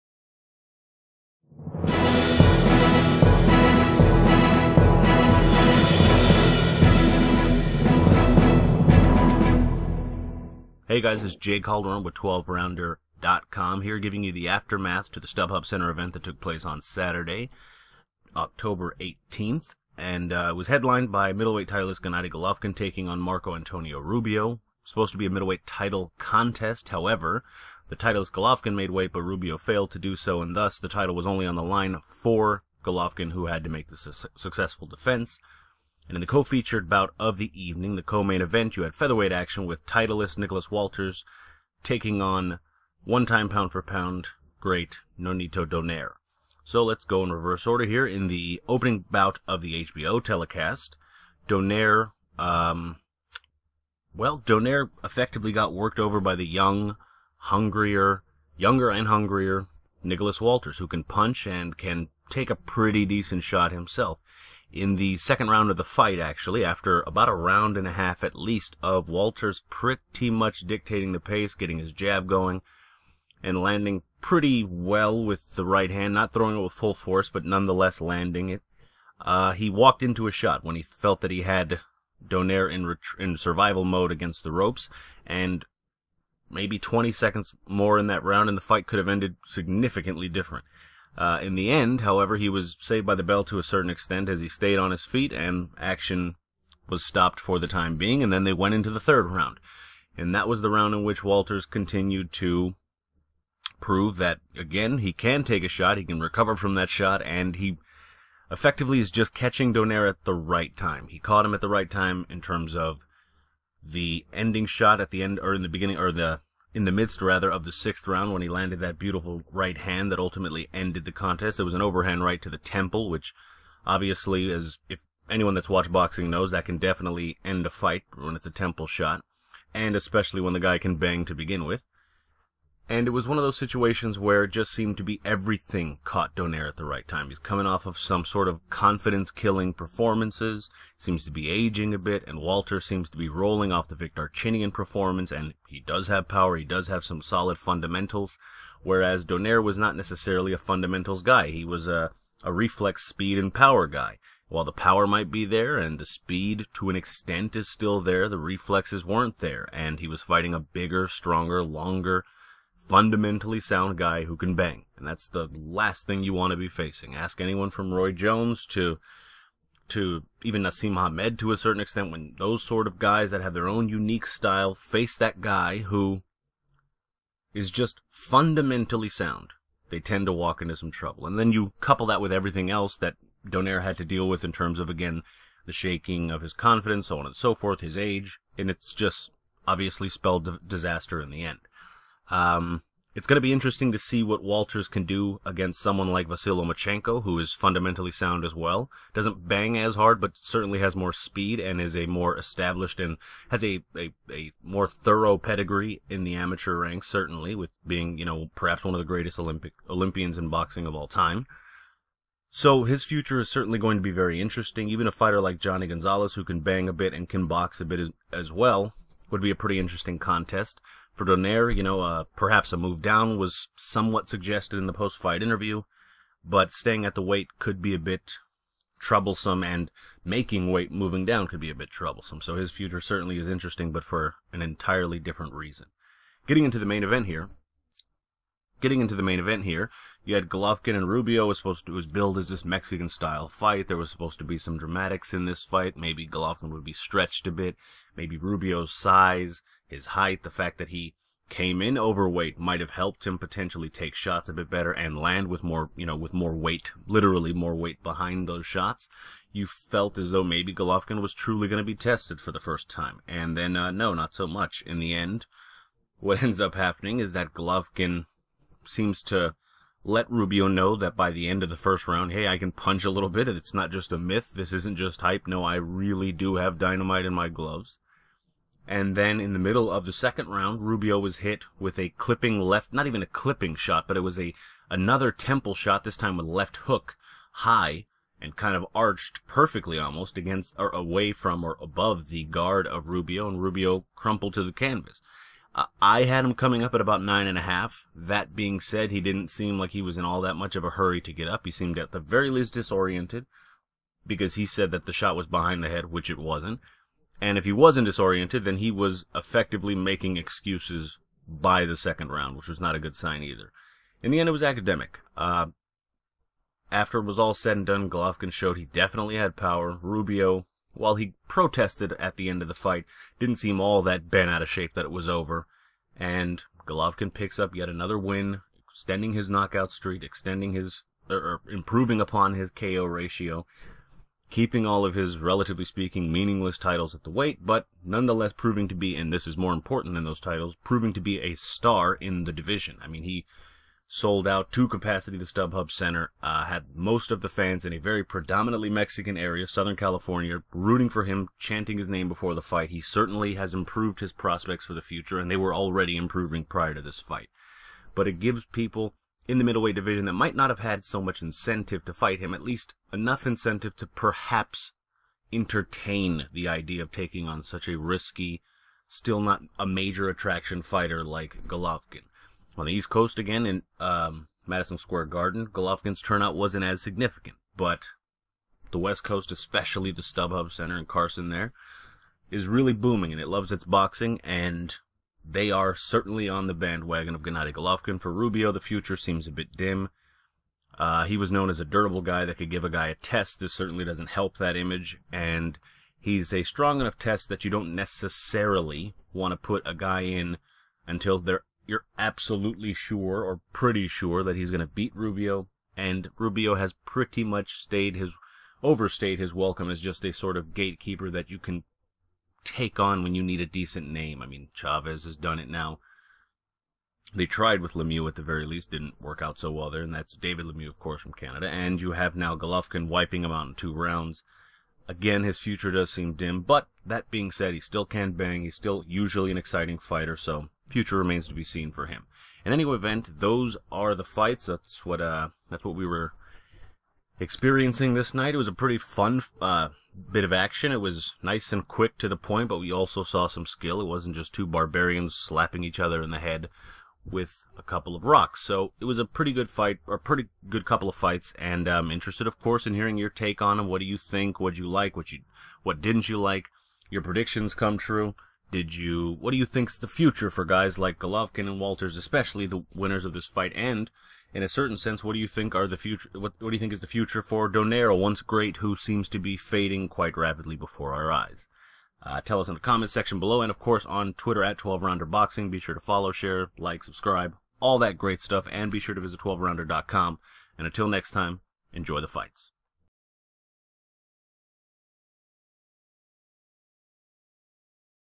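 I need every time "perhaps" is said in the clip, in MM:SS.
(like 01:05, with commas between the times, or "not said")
03:28, 03:42, 06:04.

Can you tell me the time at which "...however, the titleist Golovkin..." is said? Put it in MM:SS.
00:26.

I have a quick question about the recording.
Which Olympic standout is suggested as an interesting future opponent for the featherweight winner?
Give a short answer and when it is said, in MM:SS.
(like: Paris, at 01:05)
Vasily Lomachenko, at 03:16.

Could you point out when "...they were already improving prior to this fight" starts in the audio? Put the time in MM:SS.
05:55.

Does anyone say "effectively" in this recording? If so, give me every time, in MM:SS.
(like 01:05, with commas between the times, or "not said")
00:55, 01:48, 05:09.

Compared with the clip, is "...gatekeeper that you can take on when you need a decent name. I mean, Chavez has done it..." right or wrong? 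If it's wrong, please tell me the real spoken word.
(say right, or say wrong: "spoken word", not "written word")
right.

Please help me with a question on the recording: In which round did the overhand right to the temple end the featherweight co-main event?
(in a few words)
6th round.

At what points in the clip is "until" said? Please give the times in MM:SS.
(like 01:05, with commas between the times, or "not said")
06:41, 08:00.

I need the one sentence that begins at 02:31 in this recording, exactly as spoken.
He was a, a reflex, speed, and power guy.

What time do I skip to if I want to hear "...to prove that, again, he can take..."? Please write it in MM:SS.
01:42.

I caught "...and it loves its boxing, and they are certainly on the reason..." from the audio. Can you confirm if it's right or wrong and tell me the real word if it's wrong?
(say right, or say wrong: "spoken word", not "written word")
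wrong: "bandwagon", not "reason".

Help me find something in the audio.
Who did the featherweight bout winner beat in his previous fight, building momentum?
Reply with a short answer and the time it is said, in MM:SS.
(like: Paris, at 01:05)
Vic Darchinyan, at 02:23.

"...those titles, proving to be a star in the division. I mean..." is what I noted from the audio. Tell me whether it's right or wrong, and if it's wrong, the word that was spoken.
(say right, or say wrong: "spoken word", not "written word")
right.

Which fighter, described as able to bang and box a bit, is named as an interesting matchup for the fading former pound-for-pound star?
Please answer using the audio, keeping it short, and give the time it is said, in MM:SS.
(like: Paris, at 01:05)
Johnny Gonzalez, at 03:35.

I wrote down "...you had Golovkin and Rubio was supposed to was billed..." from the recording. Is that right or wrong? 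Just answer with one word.
right.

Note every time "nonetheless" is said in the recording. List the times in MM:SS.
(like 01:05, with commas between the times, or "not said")
01:17, 05:38.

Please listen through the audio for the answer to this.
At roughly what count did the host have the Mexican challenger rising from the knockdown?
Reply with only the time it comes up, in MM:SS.
04:57.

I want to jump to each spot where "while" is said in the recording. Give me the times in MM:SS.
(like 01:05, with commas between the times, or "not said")
02:34, 05:20.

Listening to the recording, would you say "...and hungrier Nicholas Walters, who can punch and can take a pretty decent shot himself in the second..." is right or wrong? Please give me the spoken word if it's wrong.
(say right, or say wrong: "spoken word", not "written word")
right.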